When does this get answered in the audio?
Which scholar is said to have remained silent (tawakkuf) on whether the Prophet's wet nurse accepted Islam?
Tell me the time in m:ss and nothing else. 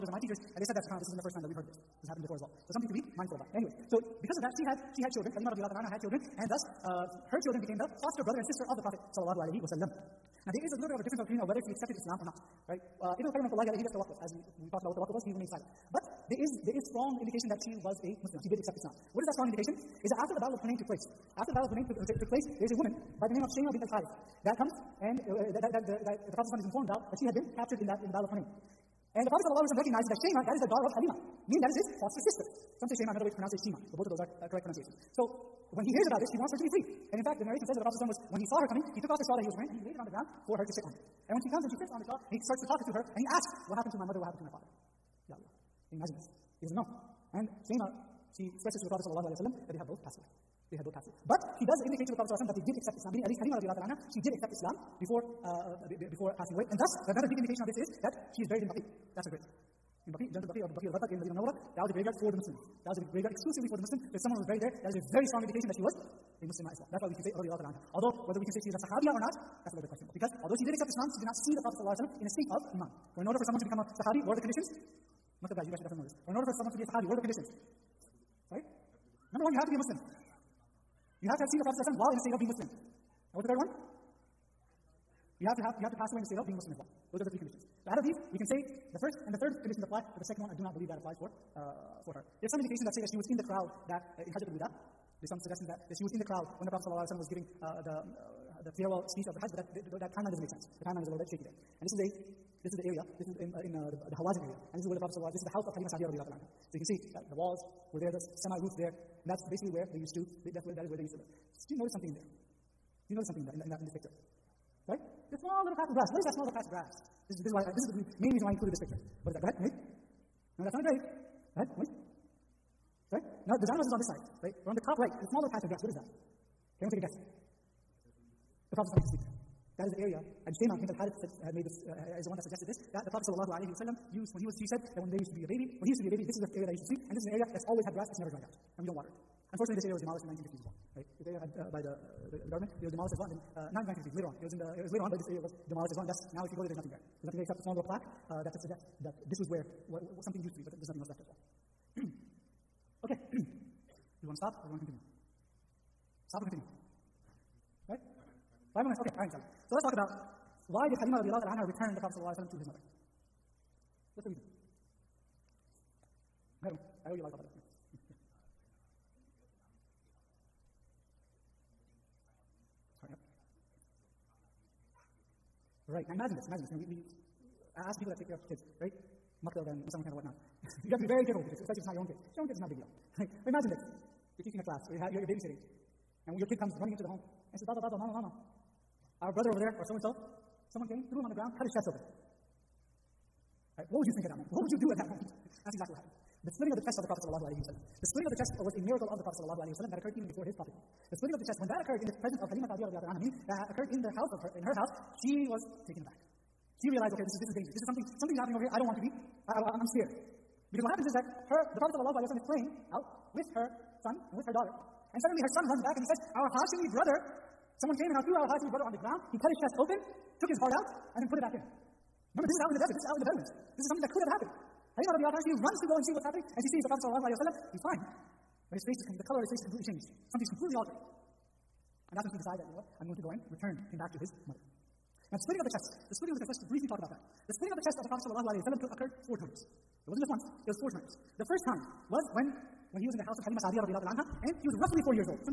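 0:13.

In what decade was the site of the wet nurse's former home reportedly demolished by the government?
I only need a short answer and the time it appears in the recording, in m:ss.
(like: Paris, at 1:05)
1950s, at 2:20.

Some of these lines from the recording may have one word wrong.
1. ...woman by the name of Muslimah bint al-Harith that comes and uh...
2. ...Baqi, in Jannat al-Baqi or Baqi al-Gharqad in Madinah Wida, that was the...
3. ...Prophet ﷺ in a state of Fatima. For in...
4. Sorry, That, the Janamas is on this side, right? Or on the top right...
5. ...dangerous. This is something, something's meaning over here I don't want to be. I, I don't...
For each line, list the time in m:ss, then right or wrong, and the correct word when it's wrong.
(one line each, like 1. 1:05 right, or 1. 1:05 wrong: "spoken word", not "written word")
1. 0:22 wrong: "Shema", not "Muslimah"
2. 1:00 wrong: "Munawwarah", not "Wida"
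3. 1:11 wrong: "Iman", not "Fatima"
4. 2:03 wrong: "Now", not "That"
5. 3:27 wrong: "happening", not "meaning".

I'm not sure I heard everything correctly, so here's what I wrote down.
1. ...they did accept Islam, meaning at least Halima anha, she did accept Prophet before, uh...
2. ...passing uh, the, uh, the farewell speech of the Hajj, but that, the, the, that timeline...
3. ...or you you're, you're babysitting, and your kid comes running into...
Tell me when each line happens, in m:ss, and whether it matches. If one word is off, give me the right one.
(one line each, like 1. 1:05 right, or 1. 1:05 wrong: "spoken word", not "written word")
1. 0:52 wrong: "Islam", not "Prophet"
2. 1:37 wrong: "giving", not "passing"
3. 3:04 right.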